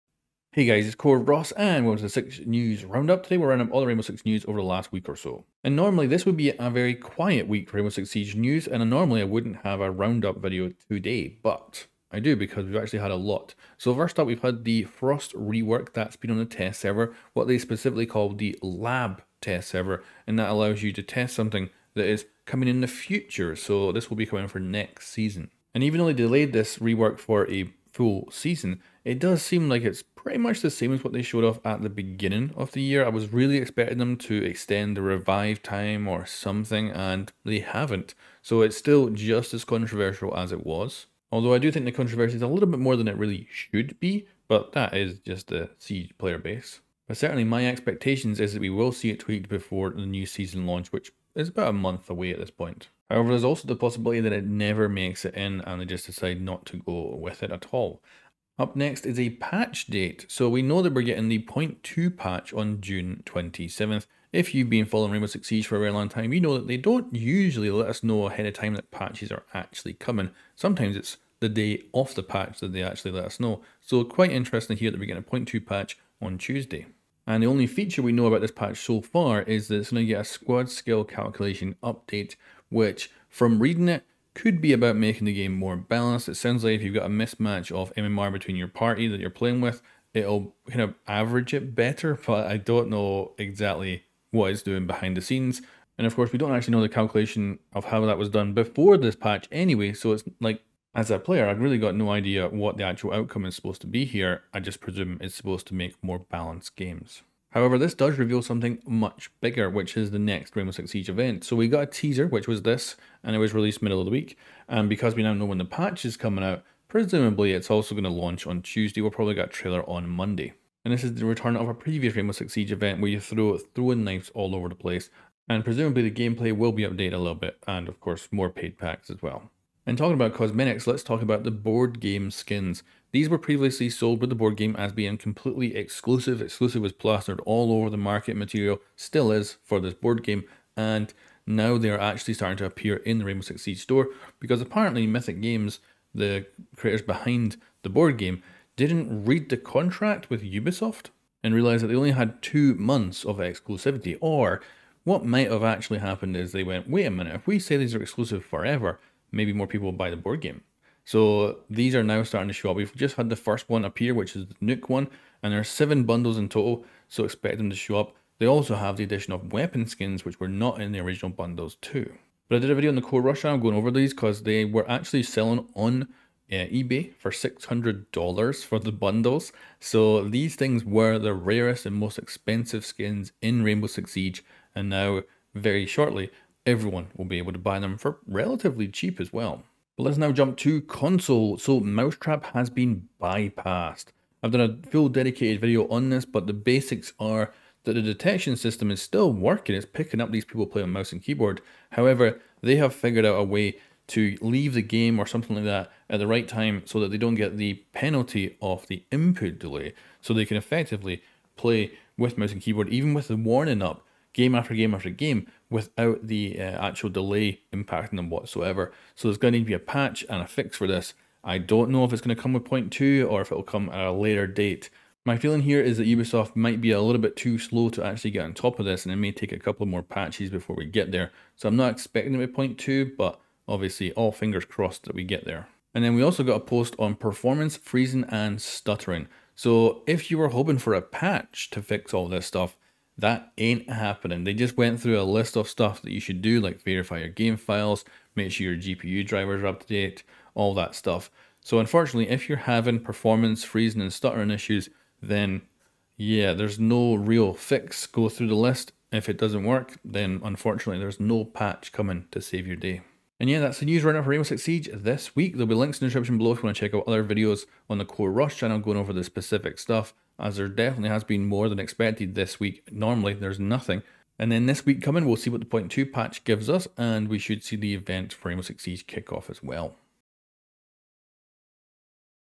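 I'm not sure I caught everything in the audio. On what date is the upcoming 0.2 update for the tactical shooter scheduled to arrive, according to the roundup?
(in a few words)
June 27th.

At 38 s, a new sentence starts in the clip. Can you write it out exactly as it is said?
So it's still just as controversial as it was.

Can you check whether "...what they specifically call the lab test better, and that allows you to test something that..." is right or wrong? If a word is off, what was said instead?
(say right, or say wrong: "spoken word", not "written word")
wrong: "server", not "better".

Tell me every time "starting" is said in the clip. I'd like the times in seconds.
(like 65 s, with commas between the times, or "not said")
142 s, 162 s.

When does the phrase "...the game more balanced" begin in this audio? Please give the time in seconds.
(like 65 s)
85 s.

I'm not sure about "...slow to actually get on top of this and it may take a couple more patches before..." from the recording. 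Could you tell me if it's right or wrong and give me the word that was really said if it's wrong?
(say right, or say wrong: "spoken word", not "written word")
right.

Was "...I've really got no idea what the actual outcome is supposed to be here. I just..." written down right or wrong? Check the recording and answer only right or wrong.
right.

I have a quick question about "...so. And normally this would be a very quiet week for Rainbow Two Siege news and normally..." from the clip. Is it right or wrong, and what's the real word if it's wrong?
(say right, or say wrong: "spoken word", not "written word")
wrong: "Six", not "Two".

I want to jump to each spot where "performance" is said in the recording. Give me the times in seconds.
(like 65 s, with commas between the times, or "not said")
237 s, 252 s.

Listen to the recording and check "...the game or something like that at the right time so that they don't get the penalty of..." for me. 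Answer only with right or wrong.
right.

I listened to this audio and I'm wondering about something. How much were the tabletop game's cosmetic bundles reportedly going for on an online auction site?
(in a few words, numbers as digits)
$600.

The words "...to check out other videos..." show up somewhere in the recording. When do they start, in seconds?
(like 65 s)
266 s.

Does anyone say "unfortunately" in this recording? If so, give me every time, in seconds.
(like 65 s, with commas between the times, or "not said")
251 s, 260 s.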